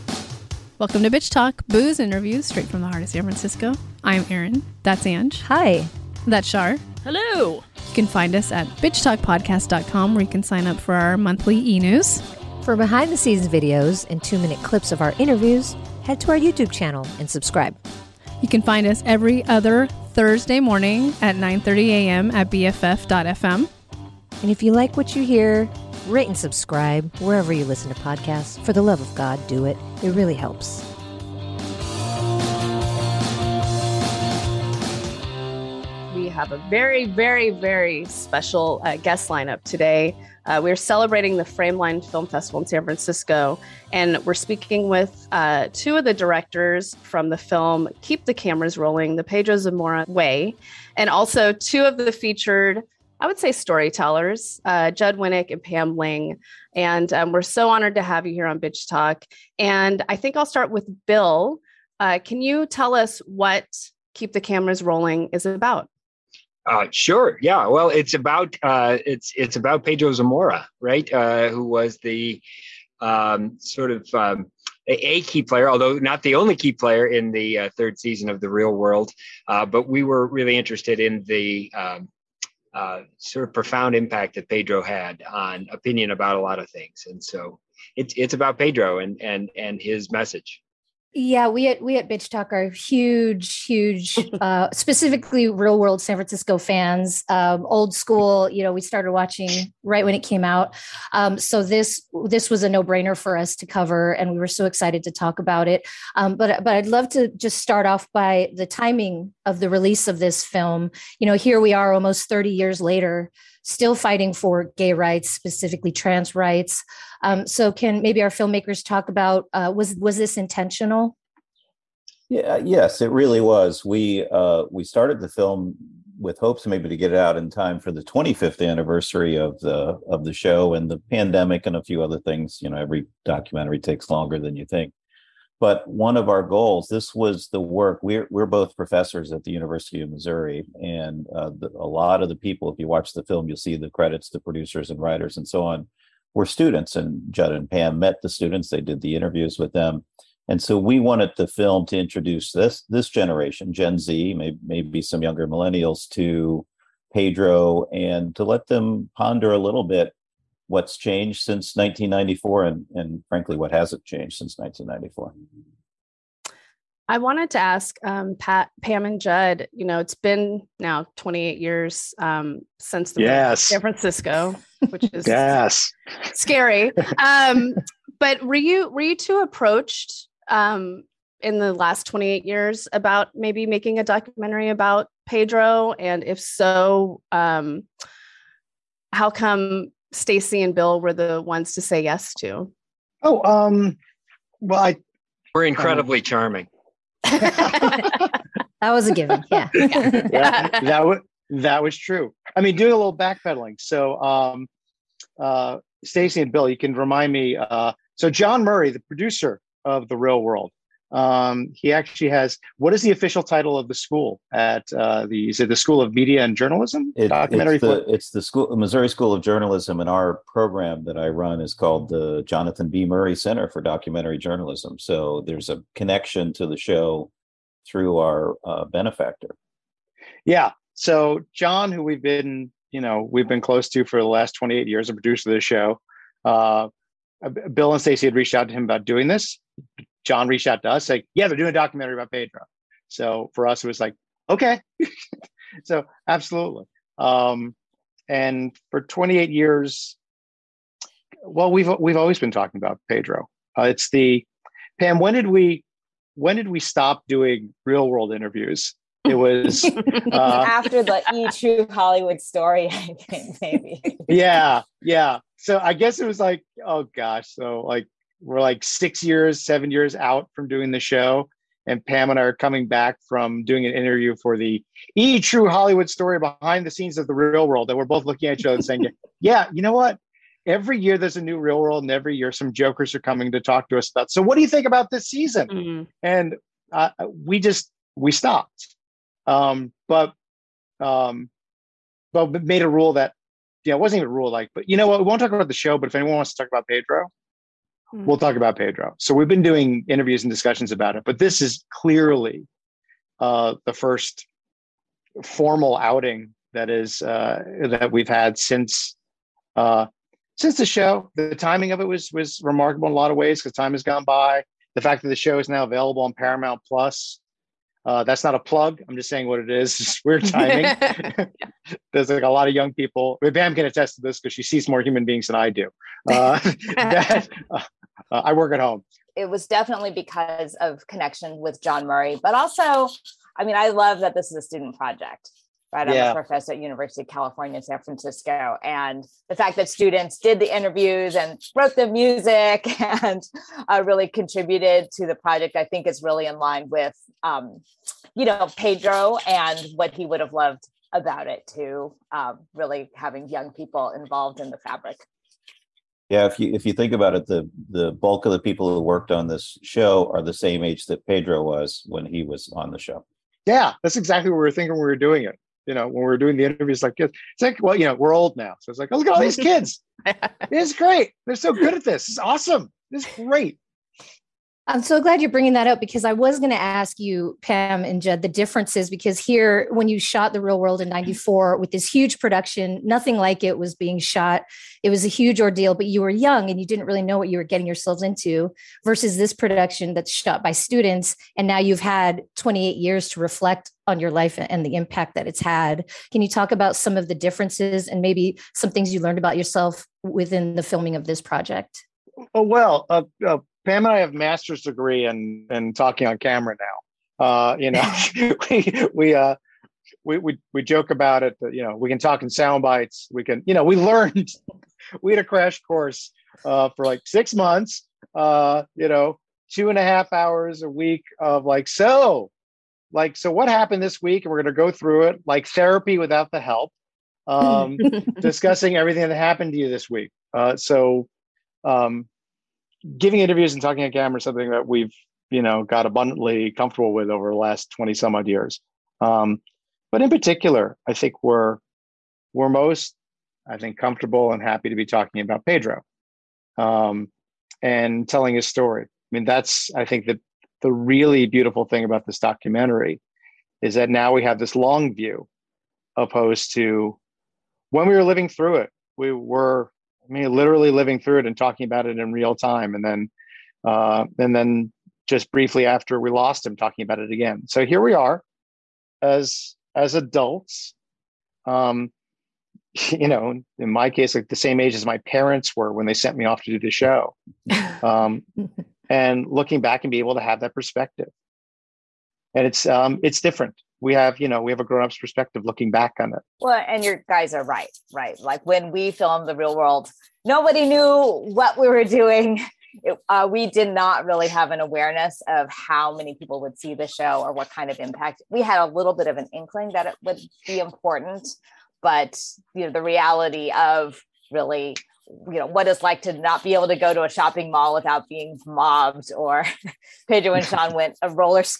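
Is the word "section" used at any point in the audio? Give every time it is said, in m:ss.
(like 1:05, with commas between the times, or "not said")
not said.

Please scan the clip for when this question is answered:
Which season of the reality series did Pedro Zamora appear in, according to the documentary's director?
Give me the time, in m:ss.
1:17.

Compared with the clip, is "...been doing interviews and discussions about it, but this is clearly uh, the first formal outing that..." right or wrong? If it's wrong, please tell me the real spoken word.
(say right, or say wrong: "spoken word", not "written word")
right.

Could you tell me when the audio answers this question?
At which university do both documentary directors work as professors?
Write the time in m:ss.
2:19.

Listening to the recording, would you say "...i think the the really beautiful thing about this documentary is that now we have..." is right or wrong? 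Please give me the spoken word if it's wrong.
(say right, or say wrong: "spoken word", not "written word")
right.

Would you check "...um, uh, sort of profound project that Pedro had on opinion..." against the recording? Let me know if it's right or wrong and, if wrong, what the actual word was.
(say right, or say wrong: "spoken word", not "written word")
wrong: "impact", not "project".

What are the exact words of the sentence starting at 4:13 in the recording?
Uh, it's the, Pam, when did we, when did we stop doing real world interviews?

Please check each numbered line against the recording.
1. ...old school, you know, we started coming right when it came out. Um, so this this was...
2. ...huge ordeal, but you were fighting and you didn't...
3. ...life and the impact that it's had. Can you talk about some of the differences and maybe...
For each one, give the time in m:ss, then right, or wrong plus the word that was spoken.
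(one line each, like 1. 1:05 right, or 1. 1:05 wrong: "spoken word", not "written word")
1. 1:37 wrong: "watching", not "coming"
2. 6:25 wrong: "young", not "fighting"
3. 6:34 right.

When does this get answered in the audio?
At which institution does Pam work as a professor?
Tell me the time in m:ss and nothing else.
5:36.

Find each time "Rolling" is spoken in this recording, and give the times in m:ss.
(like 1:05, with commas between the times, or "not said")
0:48, 1:04.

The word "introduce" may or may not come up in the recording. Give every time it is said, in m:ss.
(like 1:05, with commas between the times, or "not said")
2:31.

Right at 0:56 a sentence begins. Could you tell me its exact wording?
And um, we're so honored to have you here on Bitch Talk.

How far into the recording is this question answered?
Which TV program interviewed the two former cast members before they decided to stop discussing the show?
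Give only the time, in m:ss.
4:35.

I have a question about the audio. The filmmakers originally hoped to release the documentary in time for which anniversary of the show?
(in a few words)
25th anniversary.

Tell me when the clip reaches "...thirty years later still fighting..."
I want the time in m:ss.
1:52.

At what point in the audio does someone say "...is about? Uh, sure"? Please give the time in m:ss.
1:05.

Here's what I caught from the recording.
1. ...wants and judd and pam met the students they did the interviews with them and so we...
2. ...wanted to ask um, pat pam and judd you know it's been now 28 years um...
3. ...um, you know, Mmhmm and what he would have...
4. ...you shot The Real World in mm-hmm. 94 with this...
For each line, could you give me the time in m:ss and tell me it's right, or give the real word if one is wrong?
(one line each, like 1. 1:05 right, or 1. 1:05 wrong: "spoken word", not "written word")
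1. 2:26 wrong: "students", not "wants"
2. 2:47 right
3. 5:47 wrong: "Pedro", not "Mmhmm"
4. 6:20 right.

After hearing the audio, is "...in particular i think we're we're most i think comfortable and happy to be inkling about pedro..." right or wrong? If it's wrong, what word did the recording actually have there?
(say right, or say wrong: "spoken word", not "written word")
wrong: "talking", not "inkling".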